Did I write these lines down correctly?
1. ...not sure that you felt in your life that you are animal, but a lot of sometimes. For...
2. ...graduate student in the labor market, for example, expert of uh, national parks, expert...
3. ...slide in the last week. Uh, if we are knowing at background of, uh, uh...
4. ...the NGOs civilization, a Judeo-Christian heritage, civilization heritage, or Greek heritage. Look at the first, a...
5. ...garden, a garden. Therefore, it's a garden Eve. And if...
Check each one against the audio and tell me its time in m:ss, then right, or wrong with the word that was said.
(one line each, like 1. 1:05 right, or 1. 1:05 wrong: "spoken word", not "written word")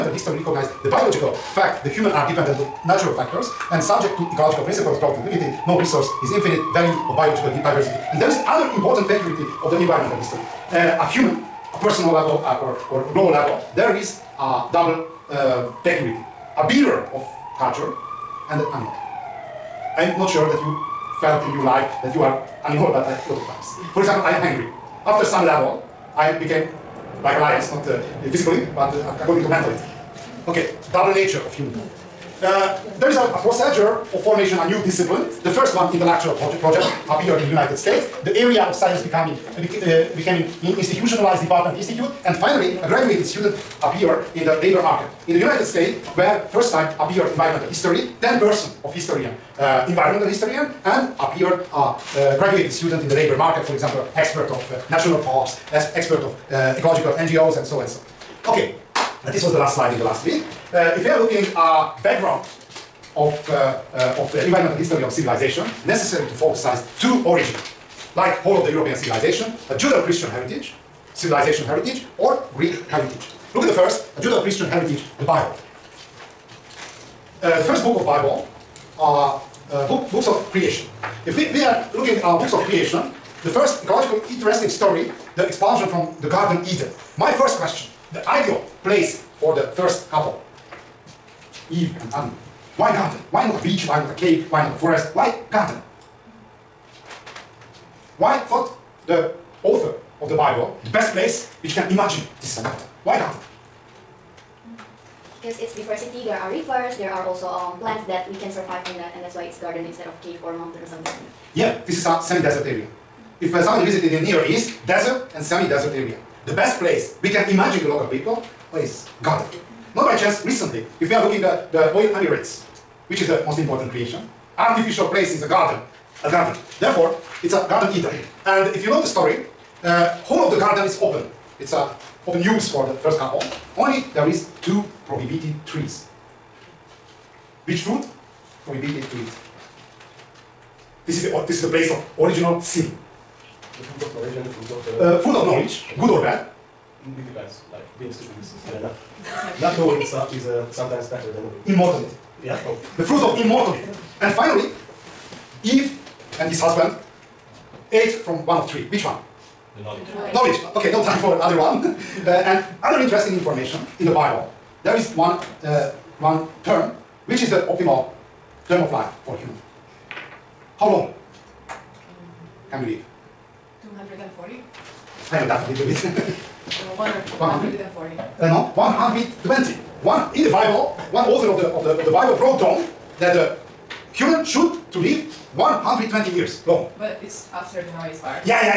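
1. 0:20 wrong: "times", not "sometimes"
2. 0:52 right
3. 0:59 wrong: "looking", not "knowing"
4. 1:08 wrong: "European", not "NGOs"
5. 2:05 wrong: "Eden", not "Eve".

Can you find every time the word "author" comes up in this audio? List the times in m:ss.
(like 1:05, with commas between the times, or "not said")
1:39, 3:01.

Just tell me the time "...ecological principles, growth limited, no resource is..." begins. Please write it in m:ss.
0:04.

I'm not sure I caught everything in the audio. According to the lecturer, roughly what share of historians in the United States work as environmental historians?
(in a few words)
10%.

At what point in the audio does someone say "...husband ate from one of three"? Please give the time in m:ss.
2:36.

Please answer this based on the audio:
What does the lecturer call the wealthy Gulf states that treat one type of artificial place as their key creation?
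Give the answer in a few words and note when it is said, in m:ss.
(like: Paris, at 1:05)
the oil emirates, at 2:01.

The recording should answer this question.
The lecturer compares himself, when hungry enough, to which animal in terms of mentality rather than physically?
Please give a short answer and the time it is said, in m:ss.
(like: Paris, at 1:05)
lion, at 0:27.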